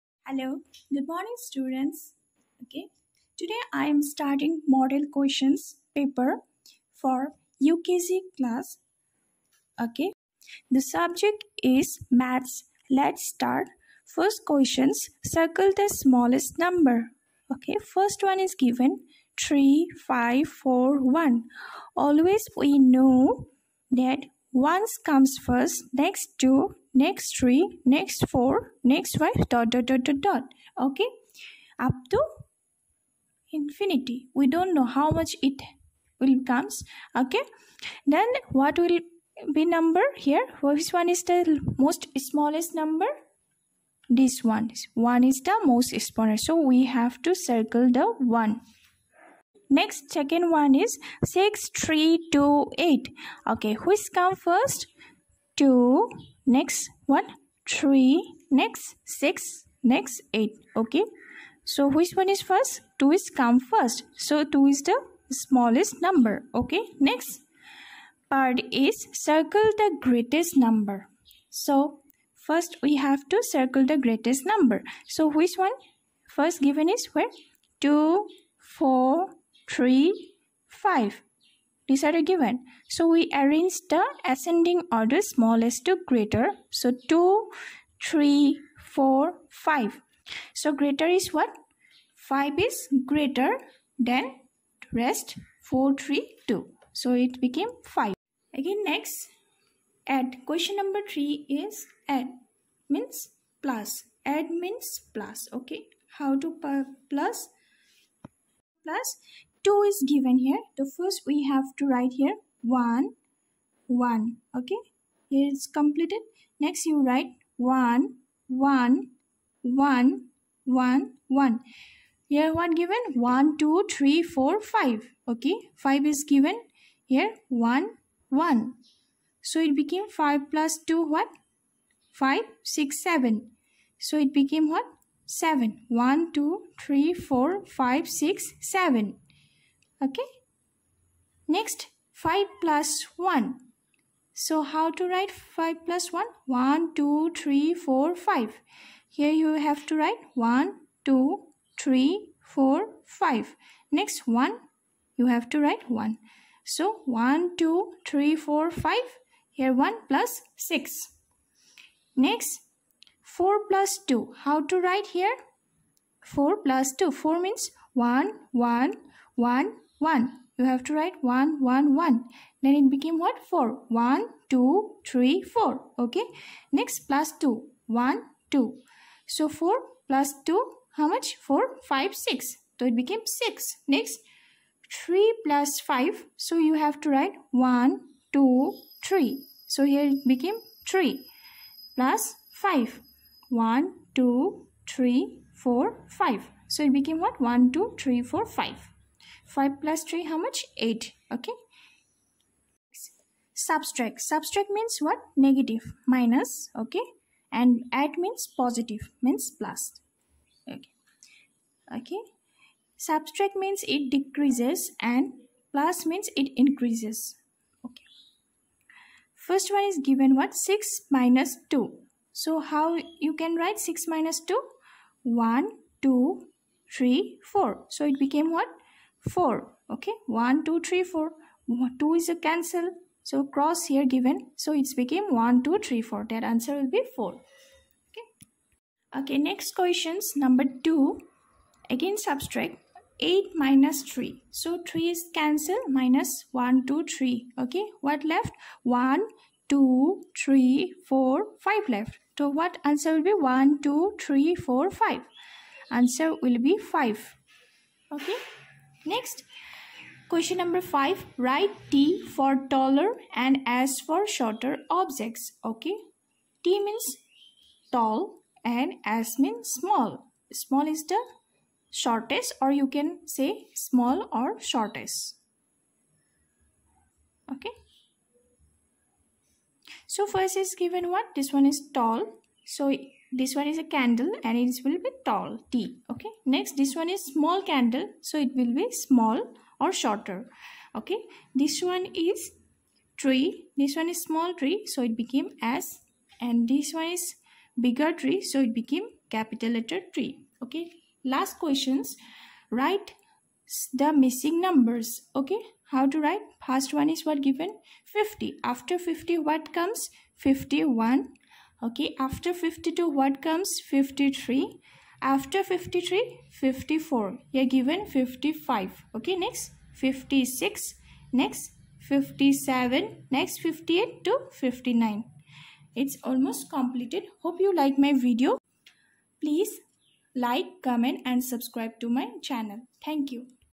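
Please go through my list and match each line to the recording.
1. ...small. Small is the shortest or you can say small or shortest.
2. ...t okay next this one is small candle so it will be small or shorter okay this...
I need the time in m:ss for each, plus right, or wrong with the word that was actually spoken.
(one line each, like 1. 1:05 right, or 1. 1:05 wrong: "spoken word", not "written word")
1. 4:29 right
2. 4:45 right.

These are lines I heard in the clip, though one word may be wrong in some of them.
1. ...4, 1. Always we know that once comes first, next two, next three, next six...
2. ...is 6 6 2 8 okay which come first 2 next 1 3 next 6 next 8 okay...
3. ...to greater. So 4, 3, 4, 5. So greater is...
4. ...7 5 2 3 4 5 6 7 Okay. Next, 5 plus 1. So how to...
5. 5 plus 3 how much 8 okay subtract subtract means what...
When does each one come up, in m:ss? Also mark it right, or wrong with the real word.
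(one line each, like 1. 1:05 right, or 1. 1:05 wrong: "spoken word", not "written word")
1. 0:20 wrong: "four", not "six"
2. 0:50 wrong: "3", not "6"
3. 1:25 wrong: "2", not "4"
4. 2:15 wrong: "1", not "5"
5. 3:19 right.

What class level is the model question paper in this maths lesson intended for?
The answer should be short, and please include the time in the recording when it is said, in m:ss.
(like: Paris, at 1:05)
UKG, at 0:07.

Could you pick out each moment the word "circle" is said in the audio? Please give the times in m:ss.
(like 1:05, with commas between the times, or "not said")
0:15, 0:47, 1:09, 1:13.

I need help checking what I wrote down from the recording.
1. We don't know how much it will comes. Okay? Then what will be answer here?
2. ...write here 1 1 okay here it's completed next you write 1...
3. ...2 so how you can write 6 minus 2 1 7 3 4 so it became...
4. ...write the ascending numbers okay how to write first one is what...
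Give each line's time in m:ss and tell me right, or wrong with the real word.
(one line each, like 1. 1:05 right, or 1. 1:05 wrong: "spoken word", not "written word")
1. 0:34 wrong: "number", not "answer"
2. 1:51 right
3. 3:41 wrong: "2", not "7"
4. 5:02 wrong: "missing", not "ascending".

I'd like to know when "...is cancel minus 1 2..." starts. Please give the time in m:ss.
4:05.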